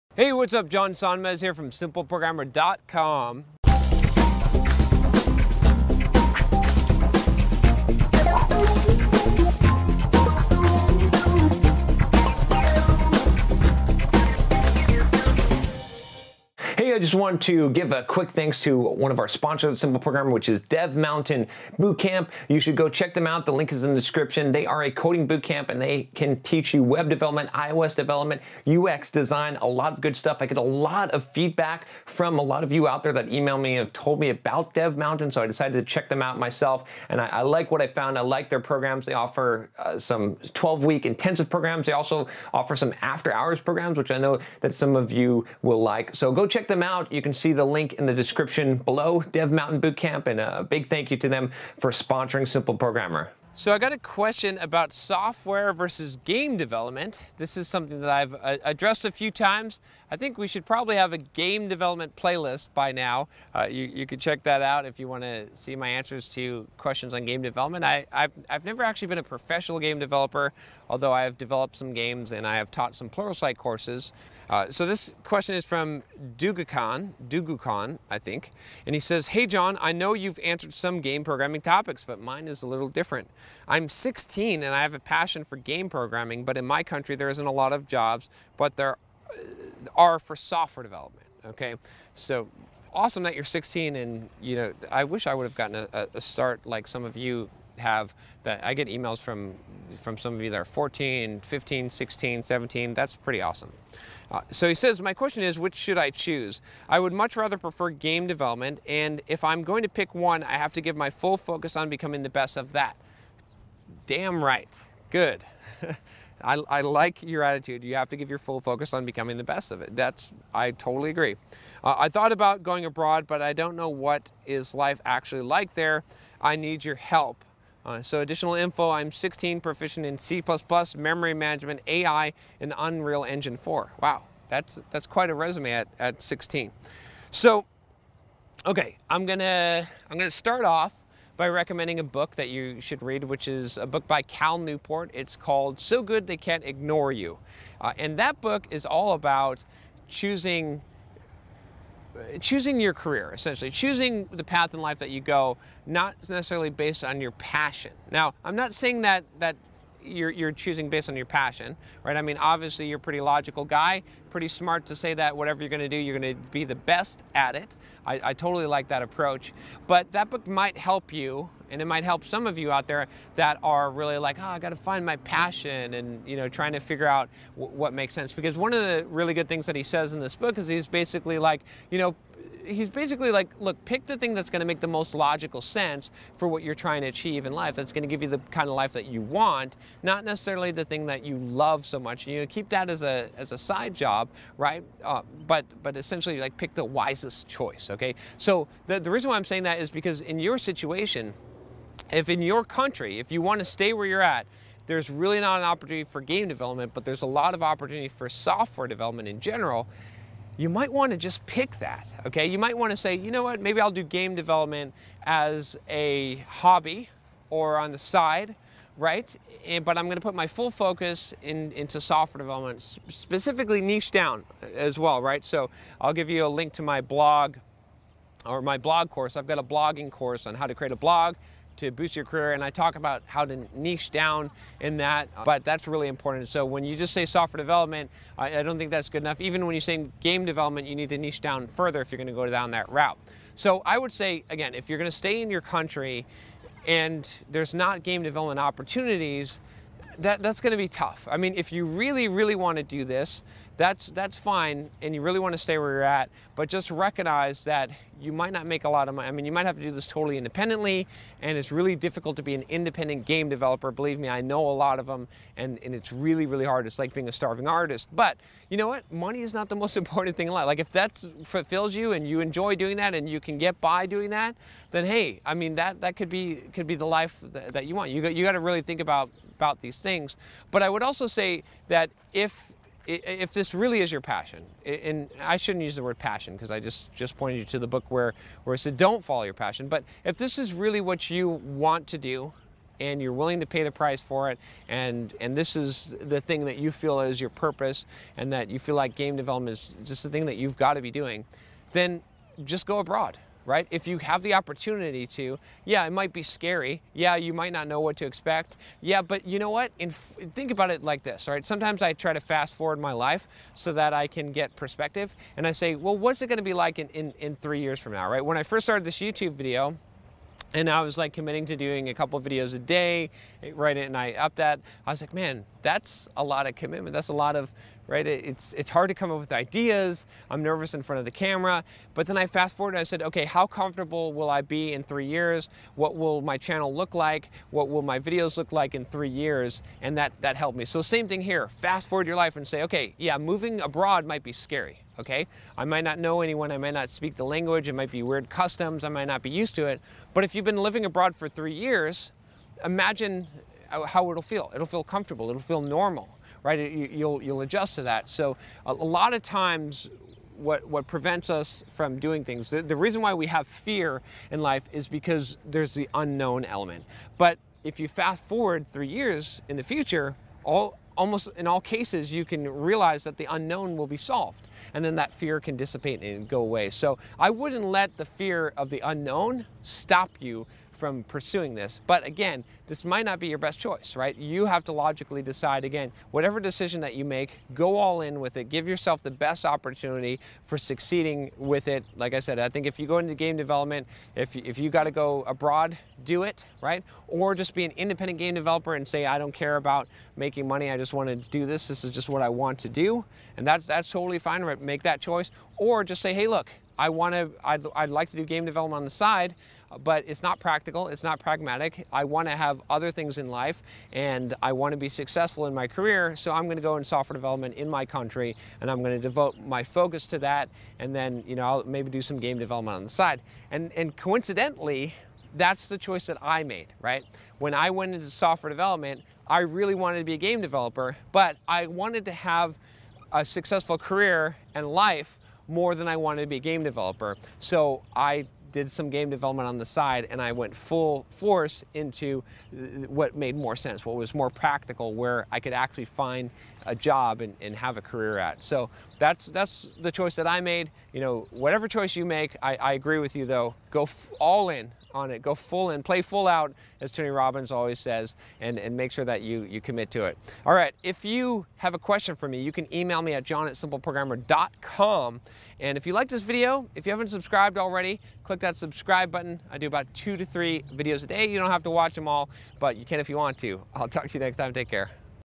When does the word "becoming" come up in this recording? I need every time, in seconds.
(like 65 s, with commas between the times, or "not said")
111 s, 119 s.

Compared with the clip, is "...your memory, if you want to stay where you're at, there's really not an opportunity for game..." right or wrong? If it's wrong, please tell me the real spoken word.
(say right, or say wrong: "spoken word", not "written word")
wrong: "country", not "memory".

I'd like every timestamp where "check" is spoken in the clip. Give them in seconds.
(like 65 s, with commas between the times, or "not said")
22 s, 35 s, 46 s, 64 s.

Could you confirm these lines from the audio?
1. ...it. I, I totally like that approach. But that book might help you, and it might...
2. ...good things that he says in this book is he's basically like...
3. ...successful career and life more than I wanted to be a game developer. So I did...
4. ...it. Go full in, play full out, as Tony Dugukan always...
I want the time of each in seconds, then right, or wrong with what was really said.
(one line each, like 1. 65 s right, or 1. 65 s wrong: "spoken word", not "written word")
1. 167 s right
2. 179 s right
3. 433 s right
4. 455 s wrong: "Robbins", not "Dugukan".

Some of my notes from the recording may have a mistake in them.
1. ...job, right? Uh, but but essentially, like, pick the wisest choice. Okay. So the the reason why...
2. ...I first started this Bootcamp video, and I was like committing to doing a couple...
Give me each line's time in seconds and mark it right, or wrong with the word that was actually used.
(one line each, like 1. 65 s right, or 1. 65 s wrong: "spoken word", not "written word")
1. 193 s right
2. 318 s wrong: "YouTube", not "Bootcamp".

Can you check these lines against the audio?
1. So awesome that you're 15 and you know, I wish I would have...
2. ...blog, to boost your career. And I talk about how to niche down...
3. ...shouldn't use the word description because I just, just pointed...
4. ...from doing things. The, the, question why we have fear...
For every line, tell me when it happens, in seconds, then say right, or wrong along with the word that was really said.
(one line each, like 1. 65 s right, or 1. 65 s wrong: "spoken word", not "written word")
1. 92 s wrong: "16", not "15"
2. 230 s right
3. 285 s wrong: "passion", not "description"
4. 361 s wrong: "reason", not "question".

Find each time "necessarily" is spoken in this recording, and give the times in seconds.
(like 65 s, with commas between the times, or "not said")
156 s, 190 s.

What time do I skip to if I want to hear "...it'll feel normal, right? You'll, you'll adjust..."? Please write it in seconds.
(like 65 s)
355 s.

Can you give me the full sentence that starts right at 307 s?
Yeah, you might not know what to expect.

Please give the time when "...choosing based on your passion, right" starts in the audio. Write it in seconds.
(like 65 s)
160 s.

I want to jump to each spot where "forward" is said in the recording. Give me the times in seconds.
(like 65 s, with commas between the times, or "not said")
312 s, 332 s, 342 s, 368 s.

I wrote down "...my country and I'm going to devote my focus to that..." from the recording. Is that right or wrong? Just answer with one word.
right.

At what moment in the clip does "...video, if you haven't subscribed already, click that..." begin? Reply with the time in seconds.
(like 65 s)
466 s.